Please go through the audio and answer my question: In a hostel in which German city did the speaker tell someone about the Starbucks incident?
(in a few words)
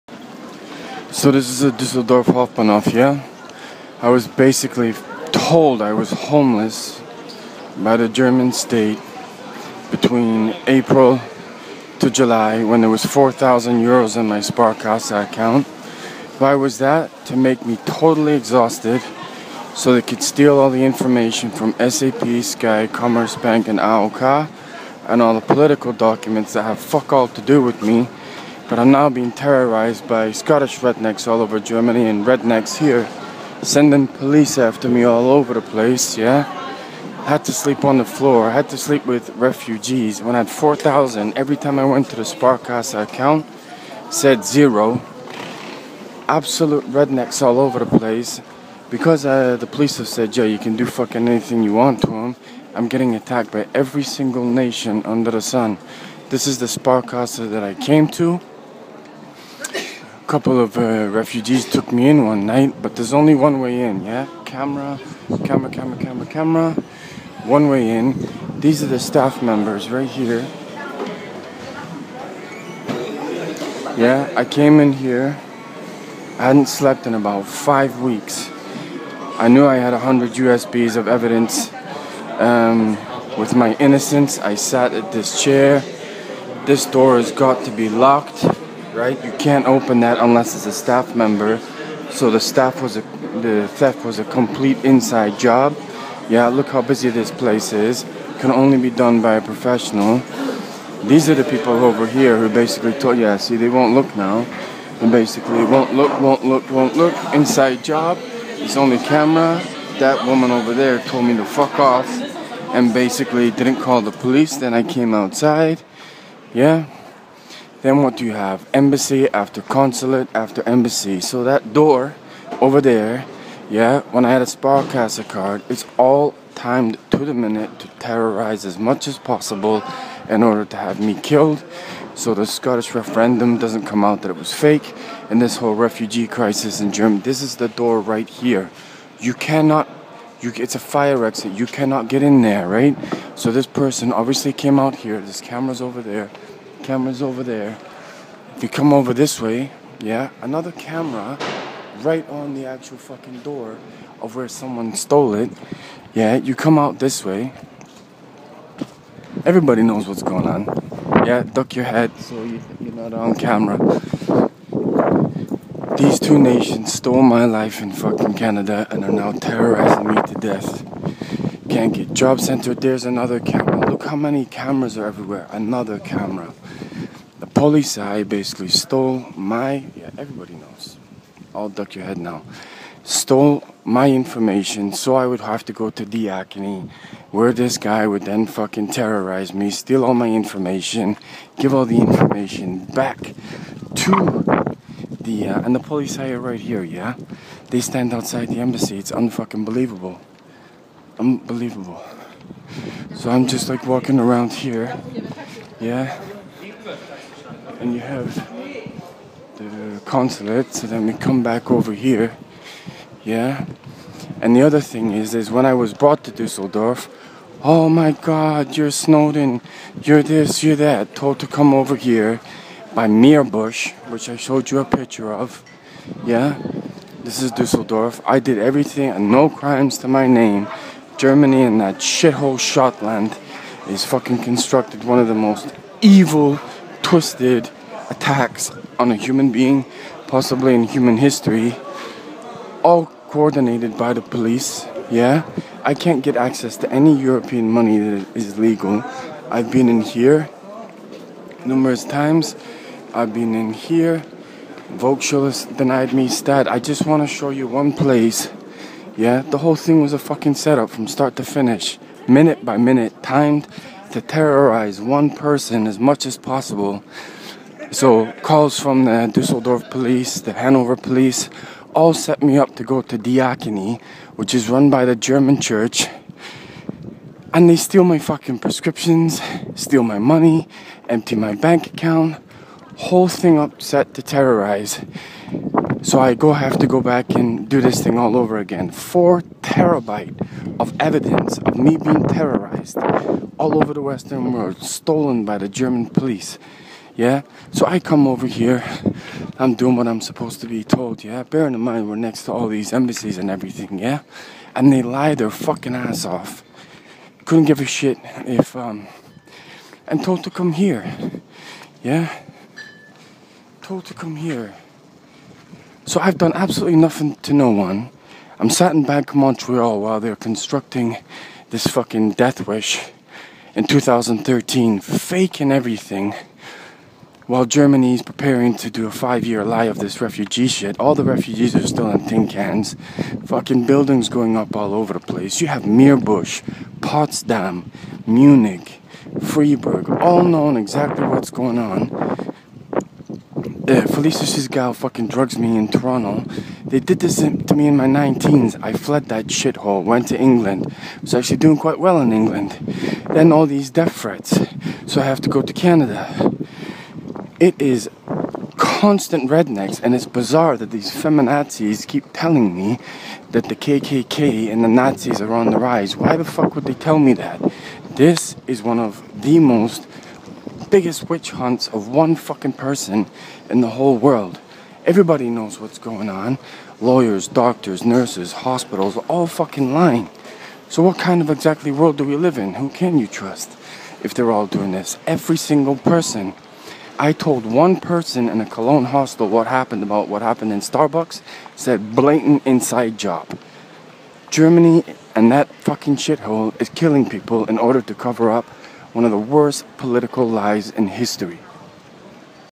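Cologne.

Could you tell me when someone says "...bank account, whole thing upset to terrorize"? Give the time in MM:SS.
04:41.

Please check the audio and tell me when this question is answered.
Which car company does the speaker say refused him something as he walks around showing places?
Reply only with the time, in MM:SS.
04:14.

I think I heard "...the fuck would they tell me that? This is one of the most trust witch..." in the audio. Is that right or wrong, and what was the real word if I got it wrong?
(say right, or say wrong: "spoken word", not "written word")
wrong: "biggest", not "trust".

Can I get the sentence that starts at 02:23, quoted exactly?
So this person obviously came out here.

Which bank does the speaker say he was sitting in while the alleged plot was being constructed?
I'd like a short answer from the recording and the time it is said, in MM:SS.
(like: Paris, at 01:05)
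Bank of Montreal, at 05:19.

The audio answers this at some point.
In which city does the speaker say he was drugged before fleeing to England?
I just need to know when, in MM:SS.
05:45.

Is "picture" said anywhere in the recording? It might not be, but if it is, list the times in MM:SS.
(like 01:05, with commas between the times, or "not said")
03:44.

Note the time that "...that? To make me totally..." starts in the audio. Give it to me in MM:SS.
00:16.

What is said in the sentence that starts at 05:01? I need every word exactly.
Bearing in mind, we're next to all these embassies and everything, yeah?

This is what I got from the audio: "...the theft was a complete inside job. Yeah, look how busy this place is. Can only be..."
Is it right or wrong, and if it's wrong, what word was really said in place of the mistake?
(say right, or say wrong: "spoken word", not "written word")
right.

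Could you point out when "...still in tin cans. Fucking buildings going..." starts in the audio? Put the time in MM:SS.
05:31.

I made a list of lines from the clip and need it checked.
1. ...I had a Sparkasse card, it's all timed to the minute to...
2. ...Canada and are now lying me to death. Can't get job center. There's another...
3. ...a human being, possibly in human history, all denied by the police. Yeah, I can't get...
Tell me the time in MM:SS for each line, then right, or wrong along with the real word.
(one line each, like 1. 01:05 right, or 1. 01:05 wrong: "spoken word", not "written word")
1. 02:04 right
2. 02:48 wrong: "terrorizing", not "lying"
3. 03:59 wrong: "coordinated", not "denied".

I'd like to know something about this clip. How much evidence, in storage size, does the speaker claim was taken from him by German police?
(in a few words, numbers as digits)
4 terabytes.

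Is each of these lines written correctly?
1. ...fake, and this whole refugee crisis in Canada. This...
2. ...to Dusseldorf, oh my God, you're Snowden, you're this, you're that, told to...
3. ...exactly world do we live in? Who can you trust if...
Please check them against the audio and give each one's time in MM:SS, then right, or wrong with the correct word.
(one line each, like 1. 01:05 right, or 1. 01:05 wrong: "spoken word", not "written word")
1. 02:14 wrong: "Germany", not "Canada"
2. 03:36 right
3. 06:21 right.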